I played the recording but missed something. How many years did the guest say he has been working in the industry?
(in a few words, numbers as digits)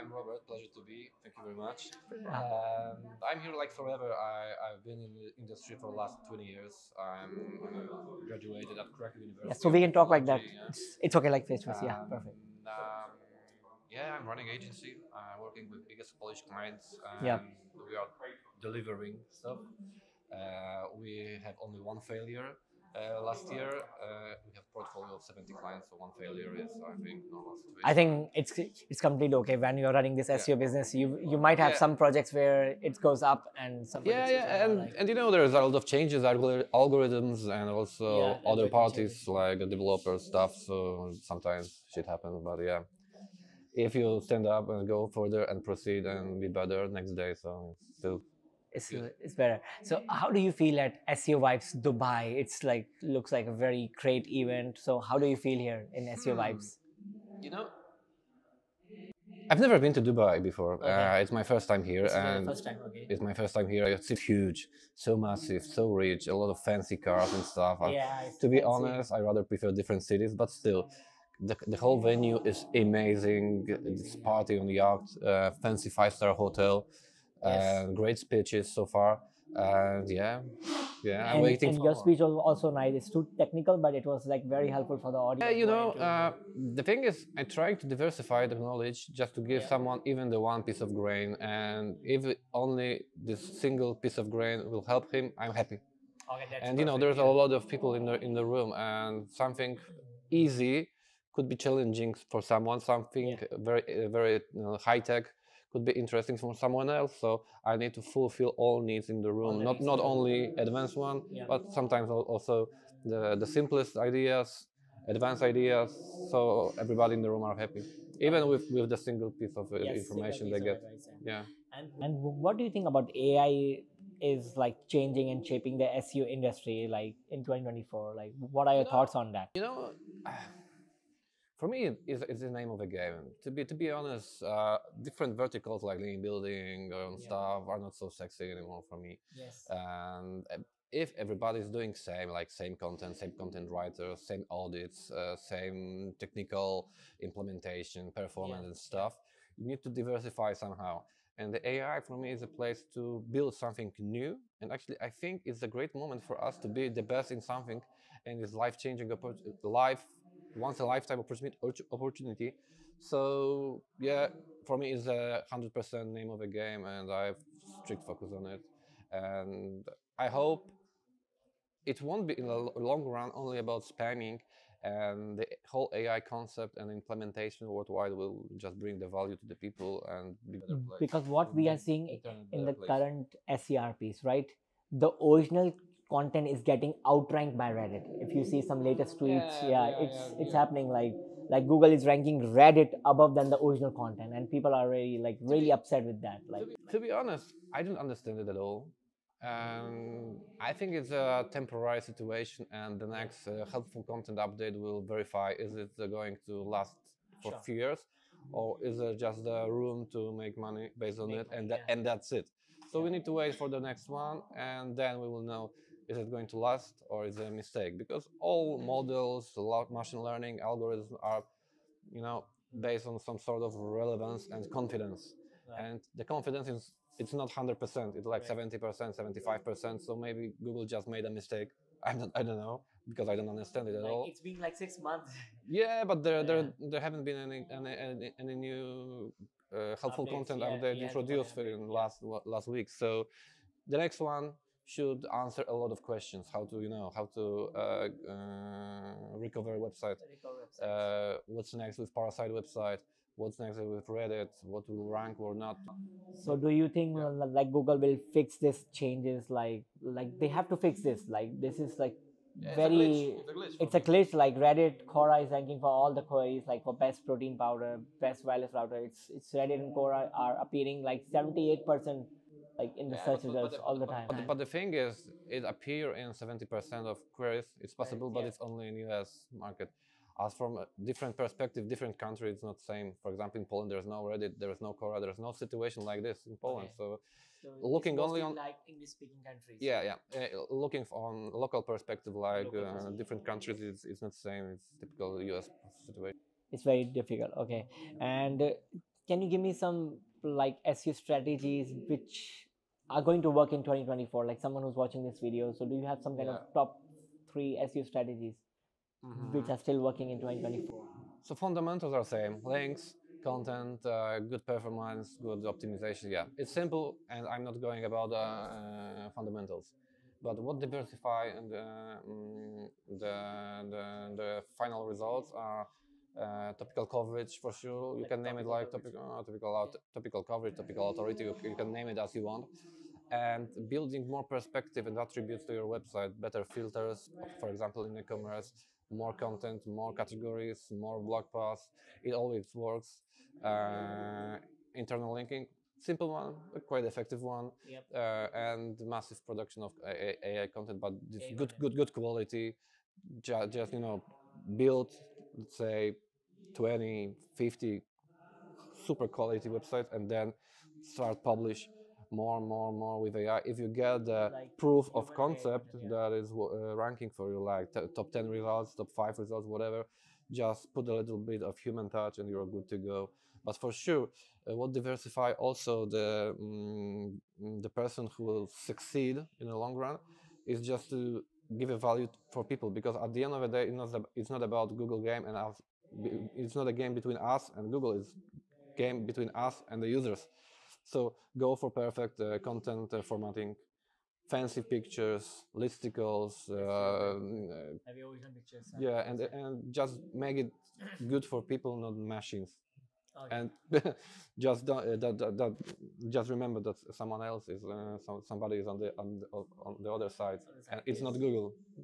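20 years.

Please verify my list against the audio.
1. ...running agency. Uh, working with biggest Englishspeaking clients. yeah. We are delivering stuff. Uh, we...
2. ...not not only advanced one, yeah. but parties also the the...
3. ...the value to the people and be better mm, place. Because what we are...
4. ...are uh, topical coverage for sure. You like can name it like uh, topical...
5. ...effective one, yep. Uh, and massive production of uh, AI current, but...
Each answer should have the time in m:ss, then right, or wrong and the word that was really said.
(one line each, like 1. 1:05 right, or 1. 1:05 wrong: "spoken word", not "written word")
1. 0:14 wrong: "Polish", not "Englishspeaking"
2. 1:49 wrong: "sometimes", not "parties"
3. 2:58 right
4. 5:25 right
5. 5:47 wrong: "content", not "current".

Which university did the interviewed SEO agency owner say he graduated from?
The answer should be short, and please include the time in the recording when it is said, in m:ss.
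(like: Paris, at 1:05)
Krakow University, at 0:08.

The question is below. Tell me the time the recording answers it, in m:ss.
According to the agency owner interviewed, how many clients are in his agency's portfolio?
0:25.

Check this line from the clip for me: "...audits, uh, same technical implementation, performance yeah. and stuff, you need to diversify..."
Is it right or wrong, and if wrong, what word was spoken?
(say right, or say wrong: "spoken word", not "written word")
right.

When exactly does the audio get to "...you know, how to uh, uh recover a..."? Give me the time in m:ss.
4:06.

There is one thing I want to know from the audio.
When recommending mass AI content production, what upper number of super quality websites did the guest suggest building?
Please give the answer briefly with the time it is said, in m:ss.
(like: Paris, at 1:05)
50, at 5:57.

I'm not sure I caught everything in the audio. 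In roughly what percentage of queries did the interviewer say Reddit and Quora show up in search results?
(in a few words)
78%.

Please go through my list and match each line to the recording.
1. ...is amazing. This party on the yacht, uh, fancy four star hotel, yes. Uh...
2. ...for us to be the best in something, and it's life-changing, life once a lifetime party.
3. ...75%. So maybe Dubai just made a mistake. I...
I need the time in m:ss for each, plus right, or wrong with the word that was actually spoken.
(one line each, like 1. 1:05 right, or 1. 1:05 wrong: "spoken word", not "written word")
1. 1:12 wrong: "five", not "four"
2. 2:36 wrong: "opportunity", not "party"
3. 3:49 wrong: "Google", not "Dubai".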